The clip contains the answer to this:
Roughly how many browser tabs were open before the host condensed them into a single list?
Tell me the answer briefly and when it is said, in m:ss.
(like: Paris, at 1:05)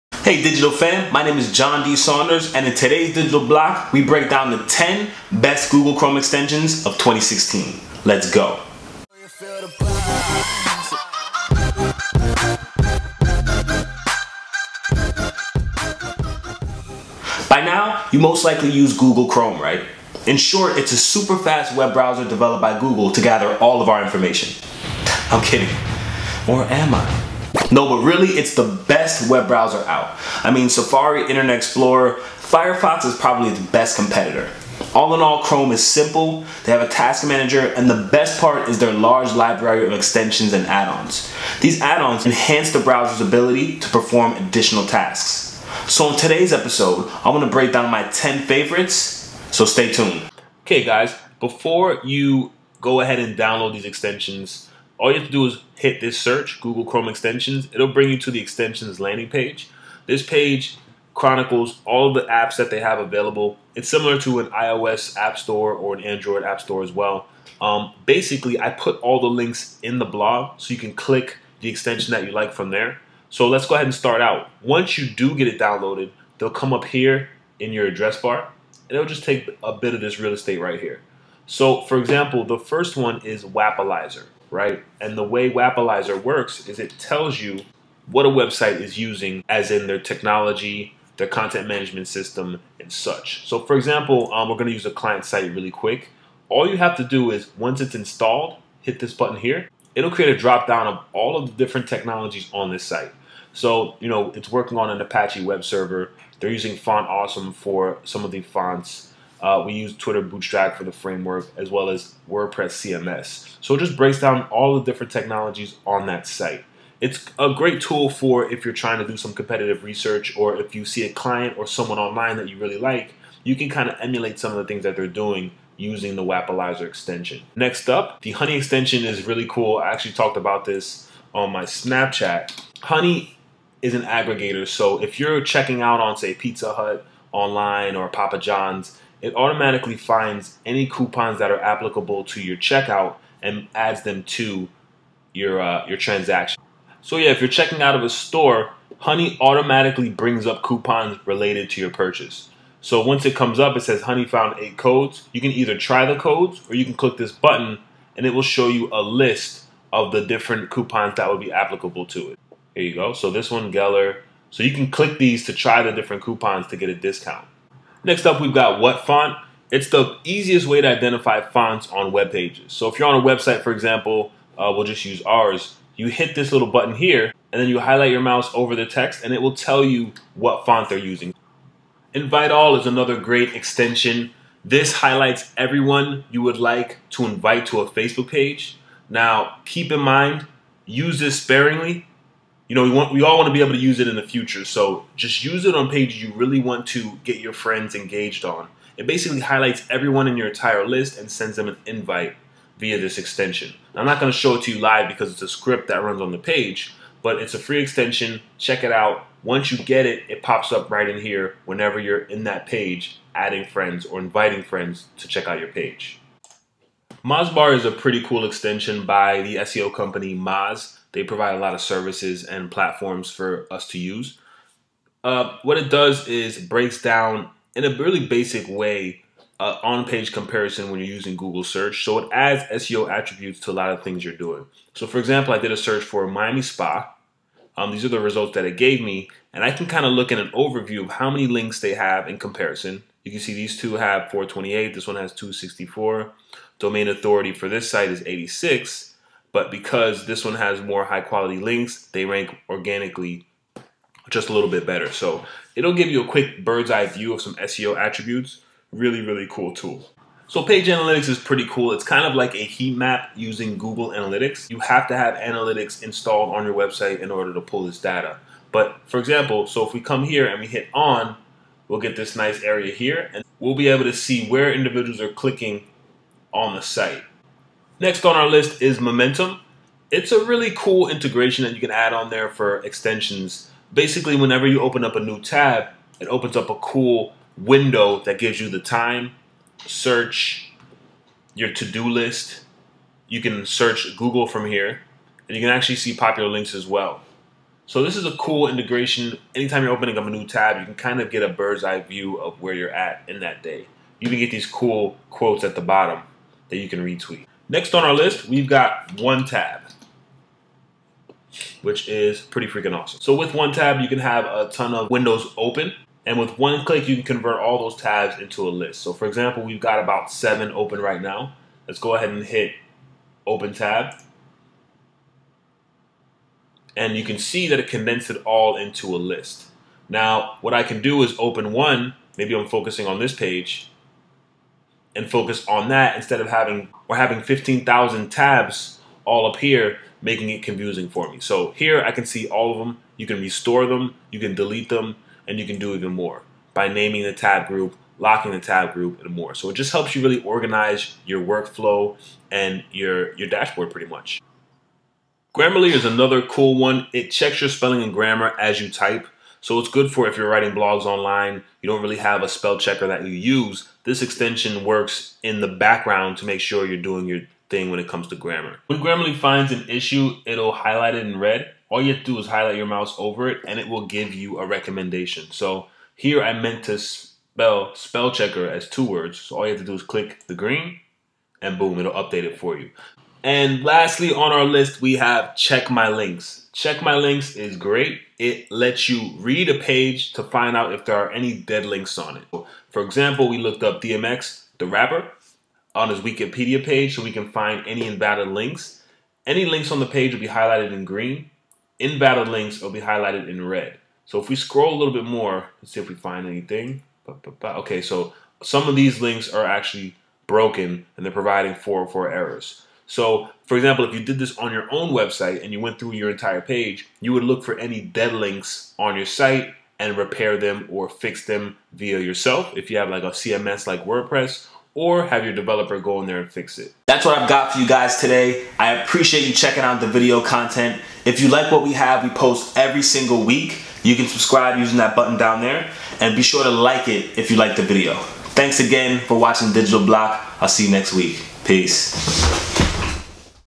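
7, at 5:20.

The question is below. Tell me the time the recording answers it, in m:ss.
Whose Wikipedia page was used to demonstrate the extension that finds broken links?
6:34.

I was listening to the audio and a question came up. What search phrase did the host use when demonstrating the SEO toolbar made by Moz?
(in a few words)
Miami Spa.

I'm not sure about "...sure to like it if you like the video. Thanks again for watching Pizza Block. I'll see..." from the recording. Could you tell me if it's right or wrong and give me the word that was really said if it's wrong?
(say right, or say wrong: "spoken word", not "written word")
wrong: "Digital", not "Pizza".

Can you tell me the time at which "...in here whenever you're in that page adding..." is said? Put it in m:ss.
3:31.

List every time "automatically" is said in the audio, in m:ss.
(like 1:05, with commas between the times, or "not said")
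2:19, 2:29.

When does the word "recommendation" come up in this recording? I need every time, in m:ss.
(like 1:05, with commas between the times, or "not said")
6:14.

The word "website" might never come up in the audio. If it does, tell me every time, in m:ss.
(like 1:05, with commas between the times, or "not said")
1:28, 2:53, 4:26, 6:55.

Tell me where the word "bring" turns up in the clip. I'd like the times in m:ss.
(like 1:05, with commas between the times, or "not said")
0:57, 2:30.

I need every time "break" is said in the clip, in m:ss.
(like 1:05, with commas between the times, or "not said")
0:04, 0:47, 1:53, 3:46.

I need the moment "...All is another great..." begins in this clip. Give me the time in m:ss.
3:02.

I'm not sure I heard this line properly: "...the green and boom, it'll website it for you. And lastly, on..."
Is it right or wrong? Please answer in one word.
wrong.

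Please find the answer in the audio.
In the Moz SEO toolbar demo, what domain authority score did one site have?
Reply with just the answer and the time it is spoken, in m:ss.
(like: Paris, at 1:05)
86, at 4:08.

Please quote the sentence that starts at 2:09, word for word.
I actually talked about this on my Snapchat.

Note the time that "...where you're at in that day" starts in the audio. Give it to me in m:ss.
5:02.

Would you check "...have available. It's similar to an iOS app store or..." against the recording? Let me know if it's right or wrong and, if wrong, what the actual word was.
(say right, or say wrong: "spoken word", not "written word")
right.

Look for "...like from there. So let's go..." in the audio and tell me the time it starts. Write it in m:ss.
1:12.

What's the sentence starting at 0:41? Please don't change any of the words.
These add-ons enhance the browser's ability to perform additional tasks.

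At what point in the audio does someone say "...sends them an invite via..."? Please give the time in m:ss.
3:21.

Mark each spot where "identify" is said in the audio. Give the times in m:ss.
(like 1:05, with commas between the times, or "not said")
2:50.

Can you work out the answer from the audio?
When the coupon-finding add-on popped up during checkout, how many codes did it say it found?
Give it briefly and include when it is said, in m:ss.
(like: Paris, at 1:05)
8, at 2:34.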